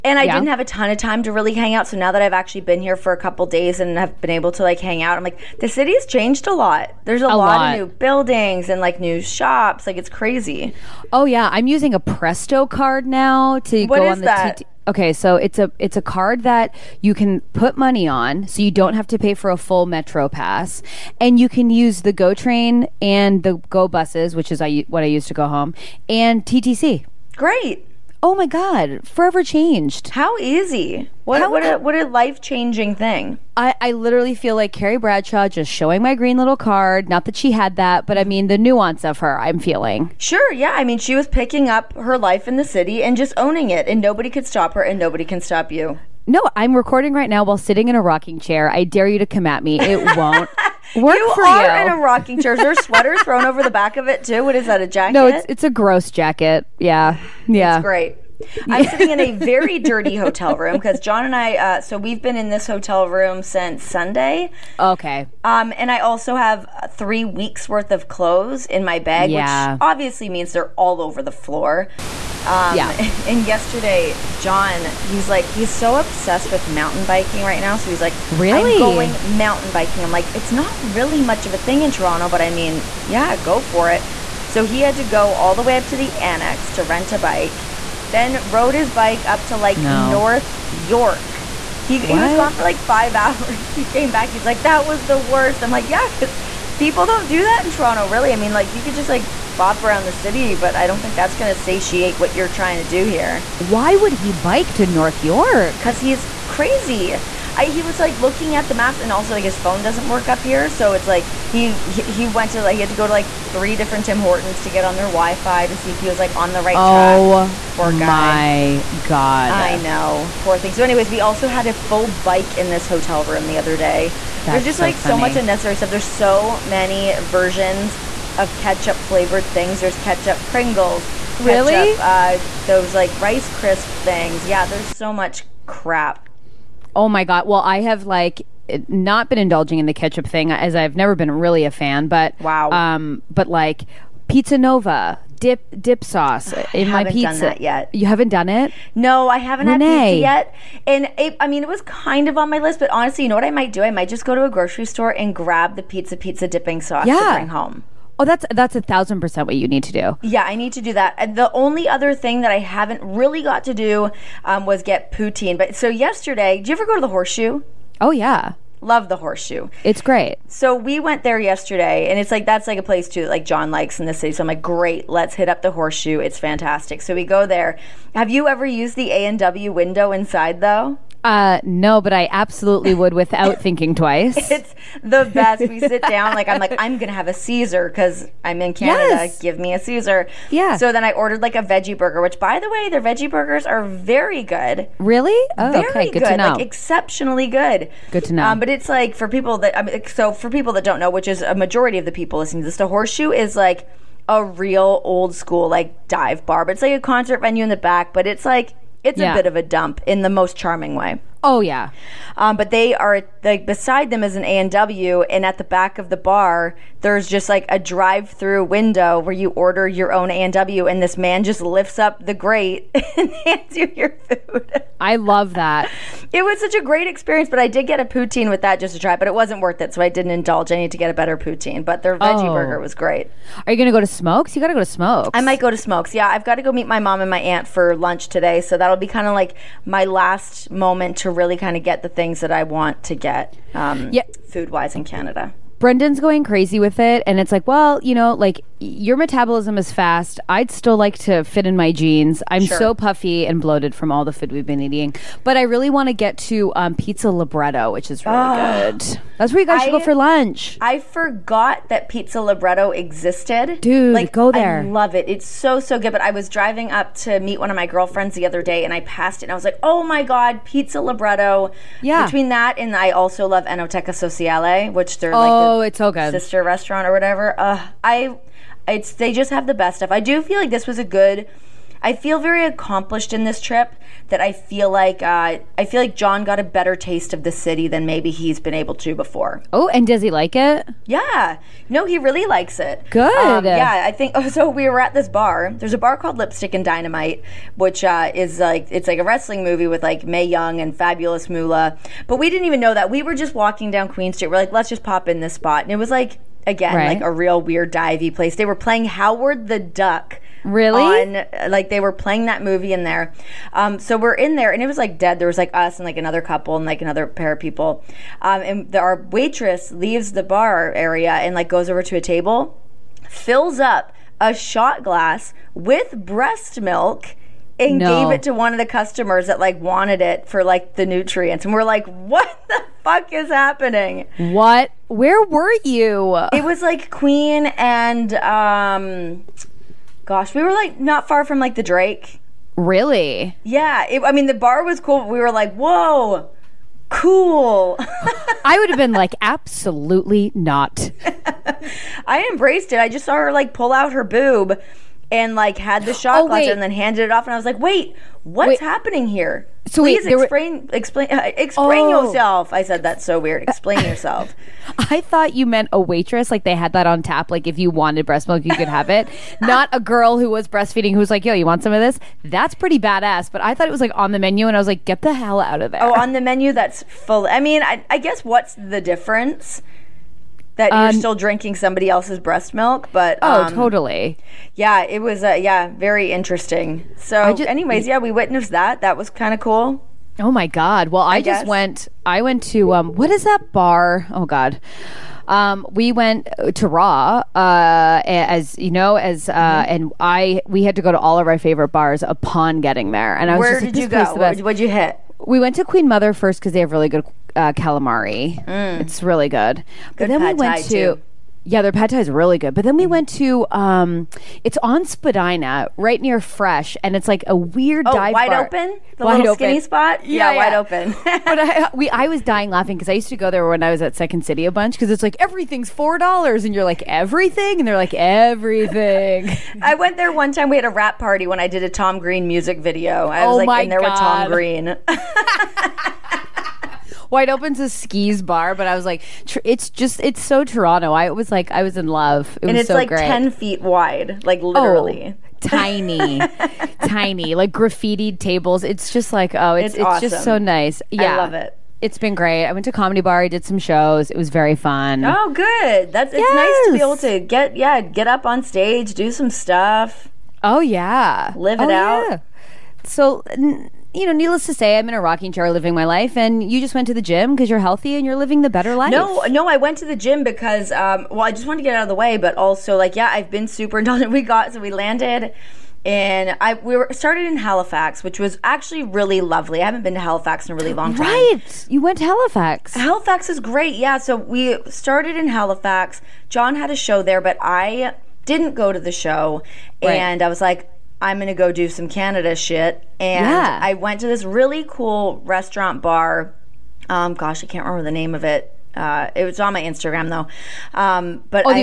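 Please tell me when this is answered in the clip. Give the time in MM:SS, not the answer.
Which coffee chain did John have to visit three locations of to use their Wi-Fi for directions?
01:54.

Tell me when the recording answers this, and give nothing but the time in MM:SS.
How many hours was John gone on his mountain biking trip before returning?
01:32.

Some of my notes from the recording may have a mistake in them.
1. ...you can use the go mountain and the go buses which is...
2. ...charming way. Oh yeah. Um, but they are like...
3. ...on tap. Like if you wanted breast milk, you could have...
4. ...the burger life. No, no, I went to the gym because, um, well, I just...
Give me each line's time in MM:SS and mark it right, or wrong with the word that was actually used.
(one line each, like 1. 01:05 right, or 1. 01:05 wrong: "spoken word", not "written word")
1. 00:21 wrong: "train", not "mountain"
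2. 03:30 right
3. 06:07 right
4. 07:48 wrong: "better", not "burger".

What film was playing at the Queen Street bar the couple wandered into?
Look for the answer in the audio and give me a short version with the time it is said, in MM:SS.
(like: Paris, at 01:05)
Howard the Duck, at 05:09.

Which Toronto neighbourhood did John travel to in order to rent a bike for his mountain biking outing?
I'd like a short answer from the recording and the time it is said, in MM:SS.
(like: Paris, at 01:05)
the Annex, at 01:26.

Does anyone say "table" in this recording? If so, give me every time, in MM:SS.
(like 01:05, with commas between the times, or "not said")
05:22, 07:28.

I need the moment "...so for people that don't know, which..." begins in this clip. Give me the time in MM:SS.
03:20.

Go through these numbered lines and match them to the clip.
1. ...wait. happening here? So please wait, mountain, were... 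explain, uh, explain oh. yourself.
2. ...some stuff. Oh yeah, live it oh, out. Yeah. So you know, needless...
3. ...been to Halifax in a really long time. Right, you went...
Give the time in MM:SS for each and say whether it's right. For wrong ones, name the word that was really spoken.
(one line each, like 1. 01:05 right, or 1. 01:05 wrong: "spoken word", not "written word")
1. 05:58 wrong: "explain", not "mountain"
2. 07:39 right
3. 08:00 right.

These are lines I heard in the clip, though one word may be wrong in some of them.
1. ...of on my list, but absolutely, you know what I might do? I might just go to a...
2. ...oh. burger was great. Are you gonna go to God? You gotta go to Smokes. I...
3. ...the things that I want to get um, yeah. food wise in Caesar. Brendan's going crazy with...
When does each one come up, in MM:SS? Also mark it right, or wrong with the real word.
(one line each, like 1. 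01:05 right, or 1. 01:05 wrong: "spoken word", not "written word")
1. 02:32 wrong: "honestly", not "absolutely"
2. 03:52 wrong: "Smokes", not "God"
3. 04:02 wrong: "Canada", not "Caesar".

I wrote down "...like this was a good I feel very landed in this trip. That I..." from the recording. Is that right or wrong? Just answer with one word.
wrong.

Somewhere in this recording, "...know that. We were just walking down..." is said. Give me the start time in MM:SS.
05:02.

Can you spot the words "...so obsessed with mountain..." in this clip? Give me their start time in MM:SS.
01:15.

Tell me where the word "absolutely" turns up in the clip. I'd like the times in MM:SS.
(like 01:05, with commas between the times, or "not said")
03:02, 05:49.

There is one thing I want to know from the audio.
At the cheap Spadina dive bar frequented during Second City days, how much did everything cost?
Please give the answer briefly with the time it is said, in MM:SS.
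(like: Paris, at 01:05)
$4, at 07:05.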